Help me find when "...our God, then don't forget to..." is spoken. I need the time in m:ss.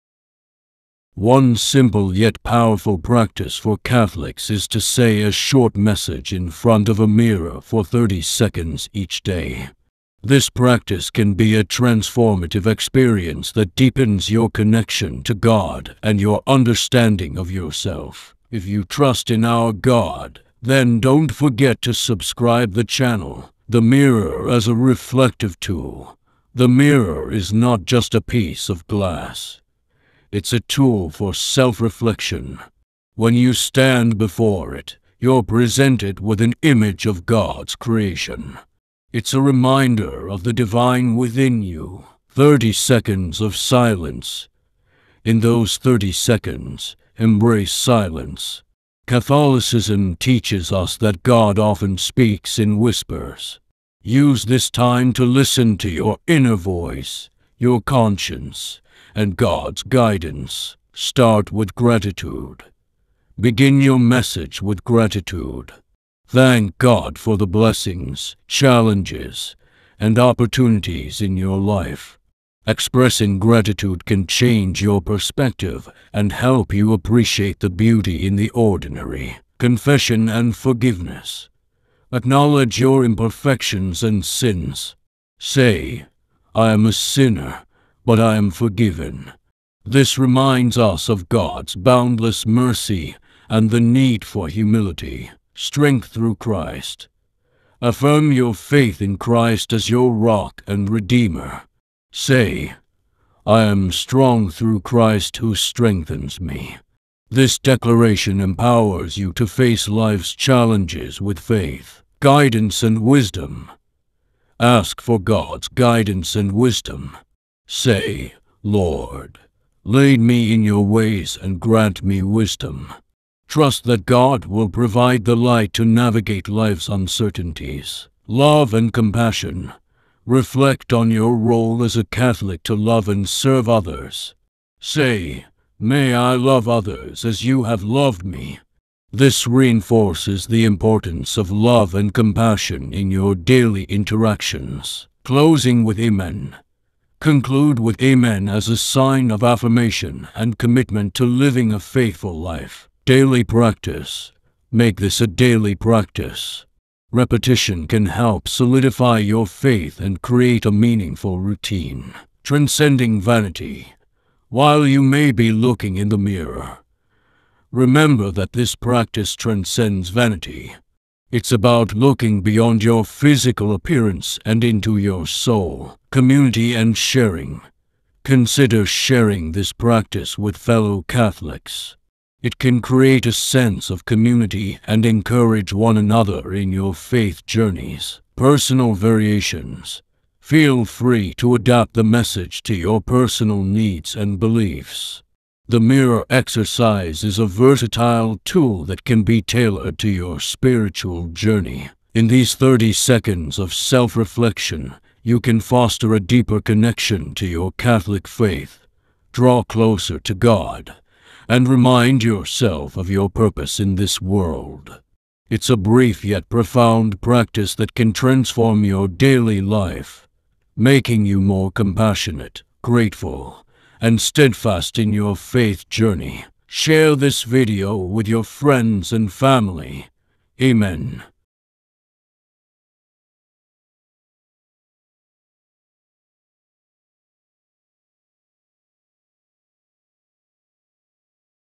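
0:19.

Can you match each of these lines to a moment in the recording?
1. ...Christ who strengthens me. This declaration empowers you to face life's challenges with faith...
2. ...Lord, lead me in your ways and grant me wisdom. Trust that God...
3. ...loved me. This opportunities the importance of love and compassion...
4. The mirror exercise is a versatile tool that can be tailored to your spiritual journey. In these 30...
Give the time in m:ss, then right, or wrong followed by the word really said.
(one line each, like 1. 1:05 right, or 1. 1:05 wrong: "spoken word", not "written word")
1. 1:44 right
2. 1:58 right
3. 2:17 wrong: "reinforces", not "opportunities"
4. 3:15 right.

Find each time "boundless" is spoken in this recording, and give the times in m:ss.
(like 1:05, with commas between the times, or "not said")
1:31.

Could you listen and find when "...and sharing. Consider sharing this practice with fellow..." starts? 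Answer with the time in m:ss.
2:56.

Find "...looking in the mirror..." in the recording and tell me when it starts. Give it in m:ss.
2:45.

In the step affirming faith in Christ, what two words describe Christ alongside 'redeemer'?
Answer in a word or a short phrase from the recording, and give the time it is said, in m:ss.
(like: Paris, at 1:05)
your rock, at 1:39.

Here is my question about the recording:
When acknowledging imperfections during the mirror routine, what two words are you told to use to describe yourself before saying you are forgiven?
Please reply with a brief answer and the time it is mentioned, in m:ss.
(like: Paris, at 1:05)
a sinner, at 1:26.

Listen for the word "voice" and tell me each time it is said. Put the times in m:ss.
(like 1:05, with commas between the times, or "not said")
0:56.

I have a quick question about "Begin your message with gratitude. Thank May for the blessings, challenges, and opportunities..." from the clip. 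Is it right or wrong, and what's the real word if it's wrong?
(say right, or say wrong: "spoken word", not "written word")
wrong: "God", not "May".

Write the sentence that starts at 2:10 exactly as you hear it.
Reflect on your role as a Catholic to love and serve others.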